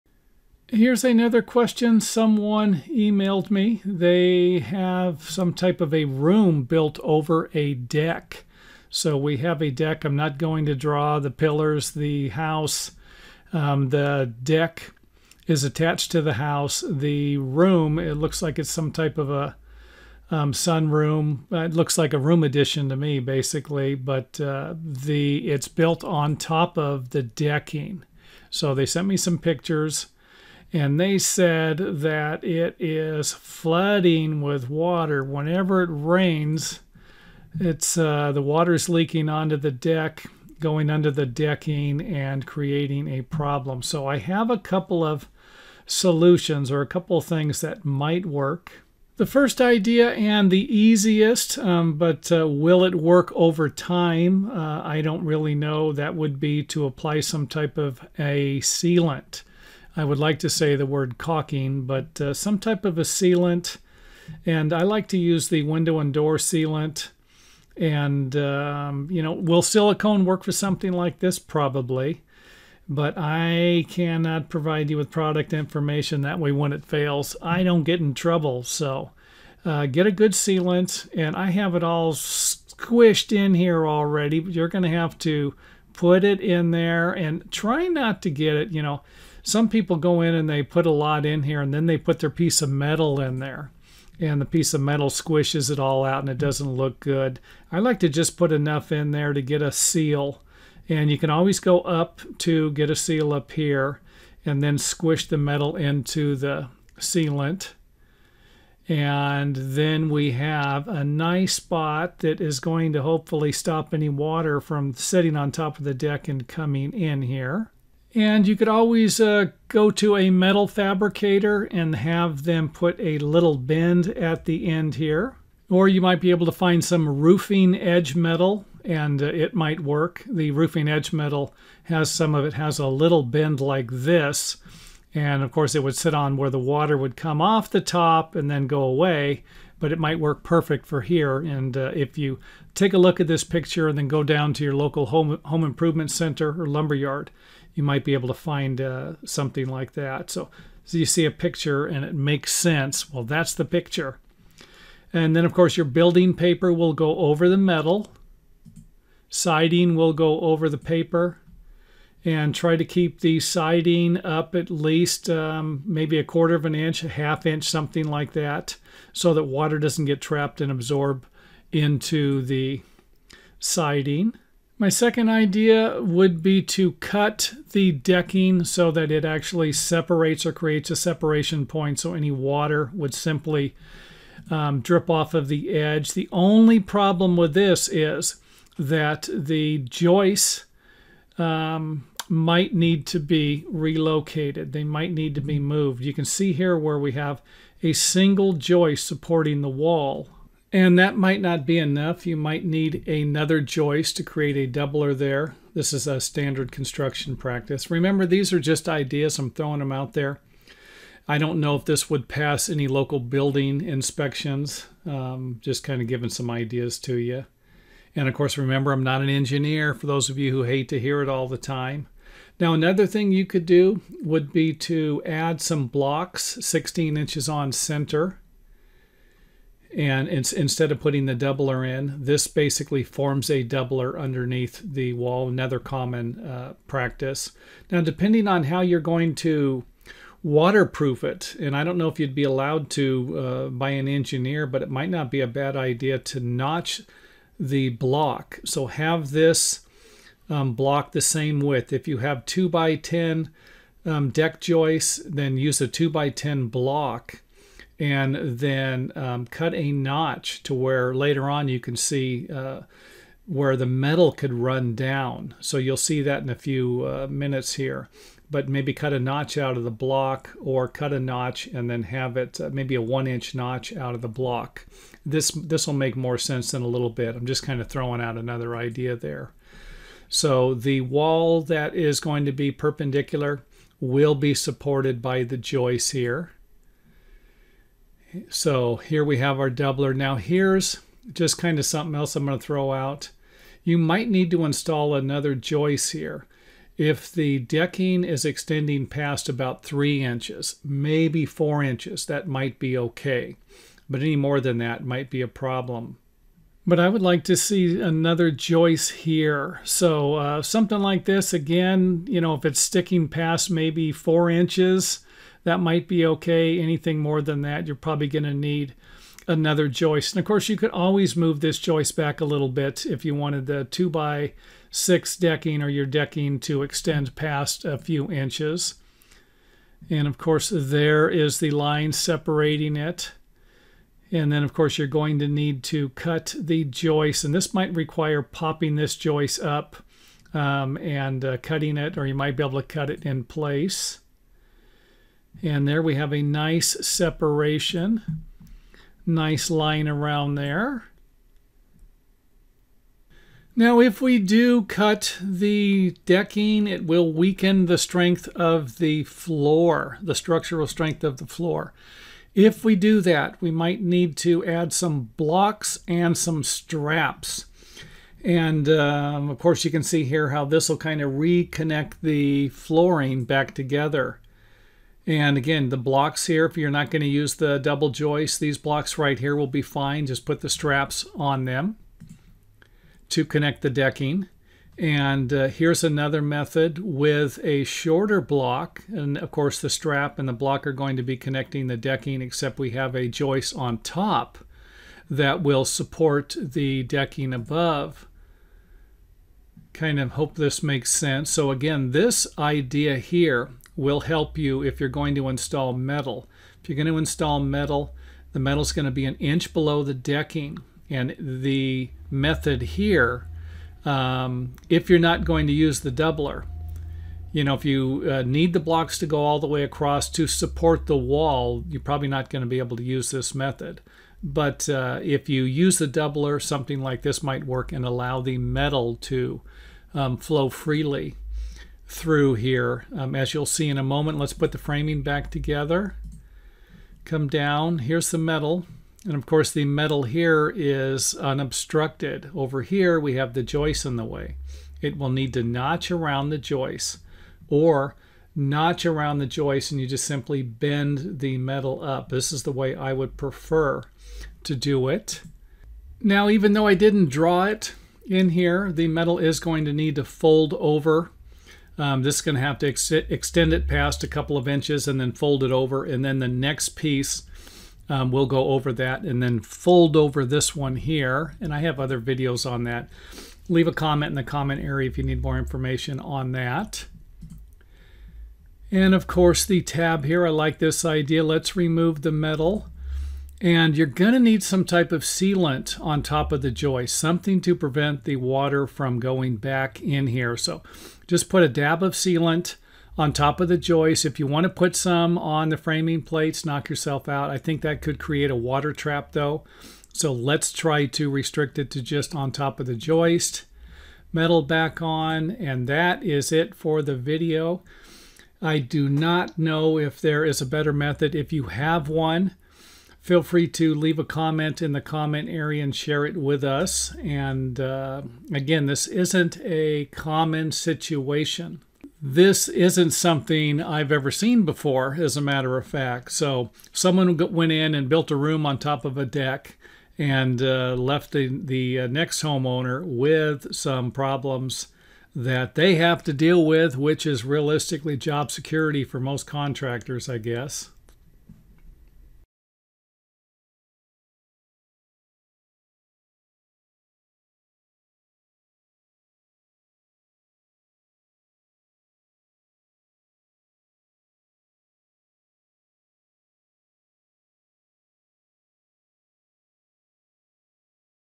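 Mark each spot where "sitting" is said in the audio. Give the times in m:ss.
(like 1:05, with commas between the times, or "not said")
1:54.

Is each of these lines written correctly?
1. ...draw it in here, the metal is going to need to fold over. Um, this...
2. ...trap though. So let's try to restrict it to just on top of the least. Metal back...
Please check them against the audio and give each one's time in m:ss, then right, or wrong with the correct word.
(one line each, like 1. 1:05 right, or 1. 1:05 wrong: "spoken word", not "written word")
1. 7:37 right
2. 8:18 wrong: "joist", not "least".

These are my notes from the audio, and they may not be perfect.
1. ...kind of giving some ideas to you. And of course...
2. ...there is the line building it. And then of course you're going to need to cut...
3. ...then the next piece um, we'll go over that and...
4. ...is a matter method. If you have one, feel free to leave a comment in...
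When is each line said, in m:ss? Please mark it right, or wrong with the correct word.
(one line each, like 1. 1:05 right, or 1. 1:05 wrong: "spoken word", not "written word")
1. 3:35 right
2. 5:30 wrong: "separating", not "building"
3. 7:46 right
4. 8:30 wrong: "better", not "matter".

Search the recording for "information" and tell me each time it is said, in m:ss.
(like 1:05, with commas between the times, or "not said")
1:15, 7:55.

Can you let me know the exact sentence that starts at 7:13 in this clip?
Um, as you'll see in a moment, let's put the framing back together.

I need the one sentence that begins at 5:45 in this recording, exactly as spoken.
And there we have a nice separation, nice line around there.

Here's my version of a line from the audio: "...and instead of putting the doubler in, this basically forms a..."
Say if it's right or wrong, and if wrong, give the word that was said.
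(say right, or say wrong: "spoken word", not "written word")
right.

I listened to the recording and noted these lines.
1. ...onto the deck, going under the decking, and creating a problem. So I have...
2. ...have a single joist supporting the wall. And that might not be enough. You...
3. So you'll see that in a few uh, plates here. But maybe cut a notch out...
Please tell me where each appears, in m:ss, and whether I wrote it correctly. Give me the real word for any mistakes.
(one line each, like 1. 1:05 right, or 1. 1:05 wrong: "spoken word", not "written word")
1. 0:39 right
2. 3:17 right
3. 4:25 wrong: "minutes", not "plates".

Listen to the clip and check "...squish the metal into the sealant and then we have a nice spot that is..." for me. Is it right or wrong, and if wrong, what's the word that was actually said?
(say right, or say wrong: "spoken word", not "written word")
right.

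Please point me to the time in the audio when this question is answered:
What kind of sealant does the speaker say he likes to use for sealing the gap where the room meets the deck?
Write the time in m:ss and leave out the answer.
1:05.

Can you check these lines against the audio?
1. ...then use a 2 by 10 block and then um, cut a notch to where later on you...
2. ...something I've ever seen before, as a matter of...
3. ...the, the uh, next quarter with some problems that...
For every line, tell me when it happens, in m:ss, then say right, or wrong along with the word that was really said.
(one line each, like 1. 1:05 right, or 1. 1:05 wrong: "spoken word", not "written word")
1. 4:15 right
2. 8:43 right
3. 8:51 wrong: "homeowner", not "quarter".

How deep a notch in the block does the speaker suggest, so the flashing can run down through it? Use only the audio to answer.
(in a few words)
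one inch.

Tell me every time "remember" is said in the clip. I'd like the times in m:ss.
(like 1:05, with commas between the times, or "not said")
3:27, 3:38.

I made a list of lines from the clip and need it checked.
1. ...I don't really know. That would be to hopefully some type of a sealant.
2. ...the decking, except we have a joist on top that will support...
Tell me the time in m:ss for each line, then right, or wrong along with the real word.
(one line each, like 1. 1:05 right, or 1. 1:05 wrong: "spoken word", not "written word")
1. 0:54 wrong: "apply", not "hopefully"
2. 6:31 right.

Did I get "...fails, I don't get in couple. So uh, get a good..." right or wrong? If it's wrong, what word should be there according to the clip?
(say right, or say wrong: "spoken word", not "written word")
wrong: "trouble", not "couple".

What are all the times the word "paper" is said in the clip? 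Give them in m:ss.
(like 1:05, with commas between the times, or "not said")
2:36, 2:40.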